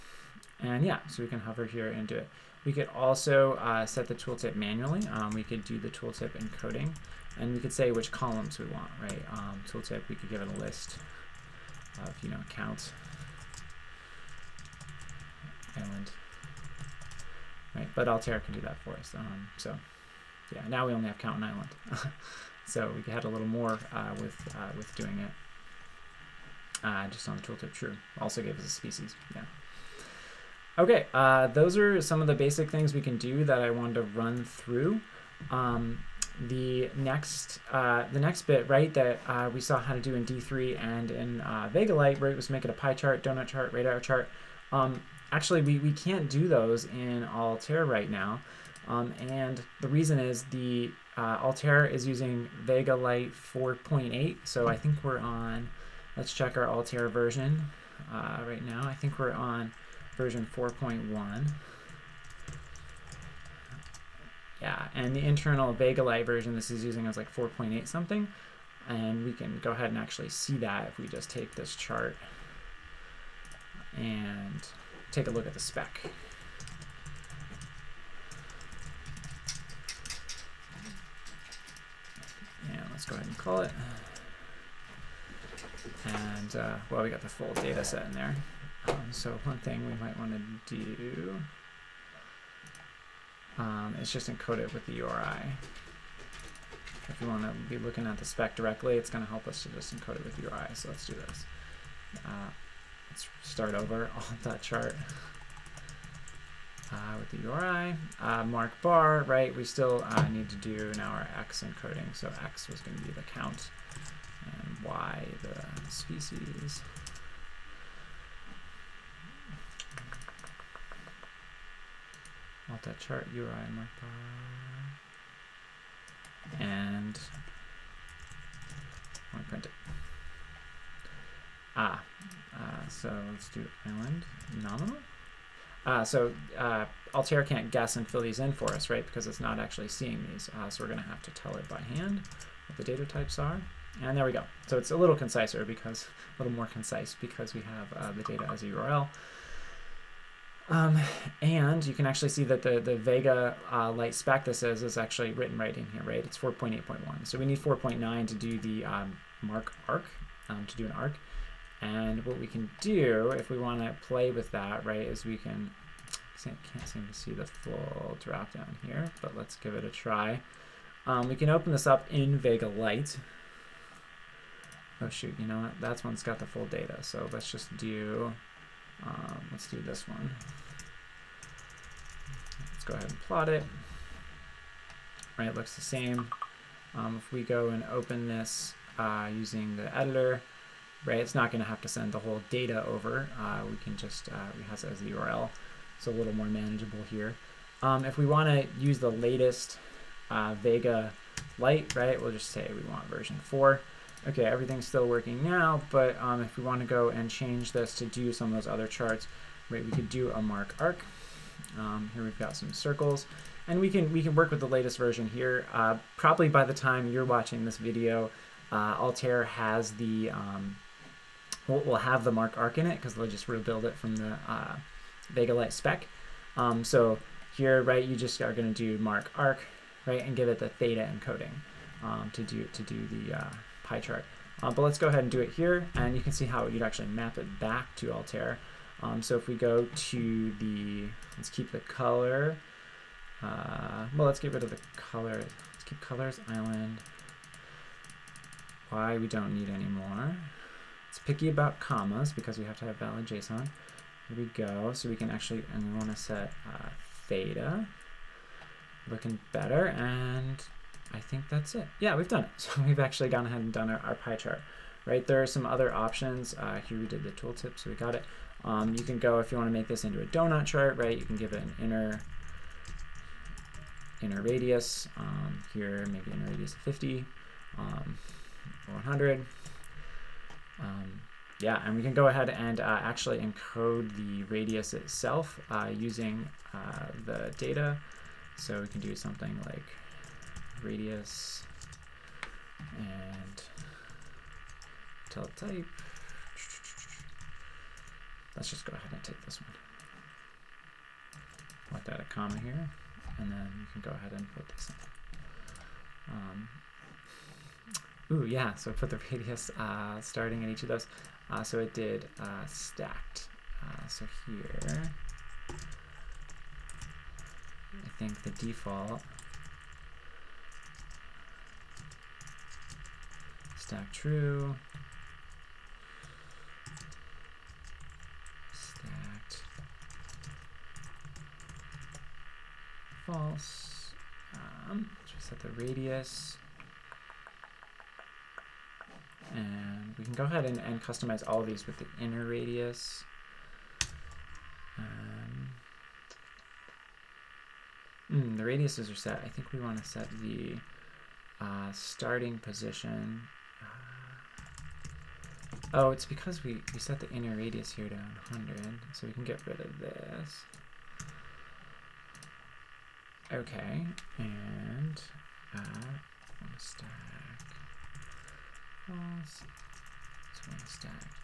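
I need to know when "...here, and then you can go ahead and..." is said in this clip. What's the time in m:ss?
5:02.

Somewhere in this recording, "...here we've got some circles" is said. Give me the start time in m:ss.
3:32.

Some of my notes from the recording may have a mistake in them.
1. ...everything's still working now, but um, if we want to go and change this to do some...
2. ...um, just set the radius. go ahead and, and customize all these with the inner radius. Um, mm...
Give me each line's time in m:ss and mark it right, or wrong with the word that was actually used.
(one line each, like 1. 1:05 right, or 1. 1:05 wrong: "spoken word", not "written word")
1. 3:24 right
2. 5:34 right.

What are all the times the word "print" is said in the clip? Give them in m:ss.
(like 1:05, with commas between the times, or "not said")
2:09.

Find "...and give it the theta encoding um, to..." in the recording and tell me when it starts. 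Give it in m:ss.
3:50.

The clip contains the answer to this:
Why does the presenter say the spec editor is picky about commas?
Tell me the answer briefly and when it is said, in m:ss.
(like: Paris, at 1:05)
valid JSON, at 4:12.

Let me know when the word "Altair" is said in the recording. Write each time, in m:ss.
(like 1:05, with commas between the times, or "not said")
0:18, 0:47, 0:51, 0:56, 2:17, 3:38, 3:58.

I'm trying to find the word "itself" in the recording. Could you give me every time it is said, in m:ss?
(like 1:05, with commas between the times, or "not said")
4:44.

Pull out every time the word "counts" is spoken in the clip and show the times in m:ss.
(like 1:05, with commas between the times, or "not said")
0:12, 1:53.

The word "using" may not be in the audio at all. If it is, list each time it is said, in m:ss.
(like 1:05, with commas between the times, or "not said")
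0:52, 1:06, 3:09, 4:45.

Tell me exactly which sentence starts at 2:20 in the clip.
Uh, so we're going to have to tell it by hand what the data types are.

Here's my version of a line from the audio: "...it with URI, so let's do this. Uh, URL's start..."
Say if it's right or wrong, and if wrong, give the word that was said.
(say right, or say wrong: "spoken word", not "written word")
wrong: "Let", not "URL".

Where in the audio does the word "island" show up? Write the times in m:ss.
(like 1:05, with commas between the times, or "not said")
0:15, 0:21, 2:13, 4:06.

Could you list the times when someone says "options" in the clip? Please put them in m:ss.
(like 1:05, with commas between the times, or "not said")
4:25.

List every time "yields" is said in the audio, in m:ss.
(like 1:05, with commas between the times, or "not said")
not said.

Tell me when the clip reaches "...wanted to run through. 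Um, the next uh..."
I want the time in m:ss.
0:33.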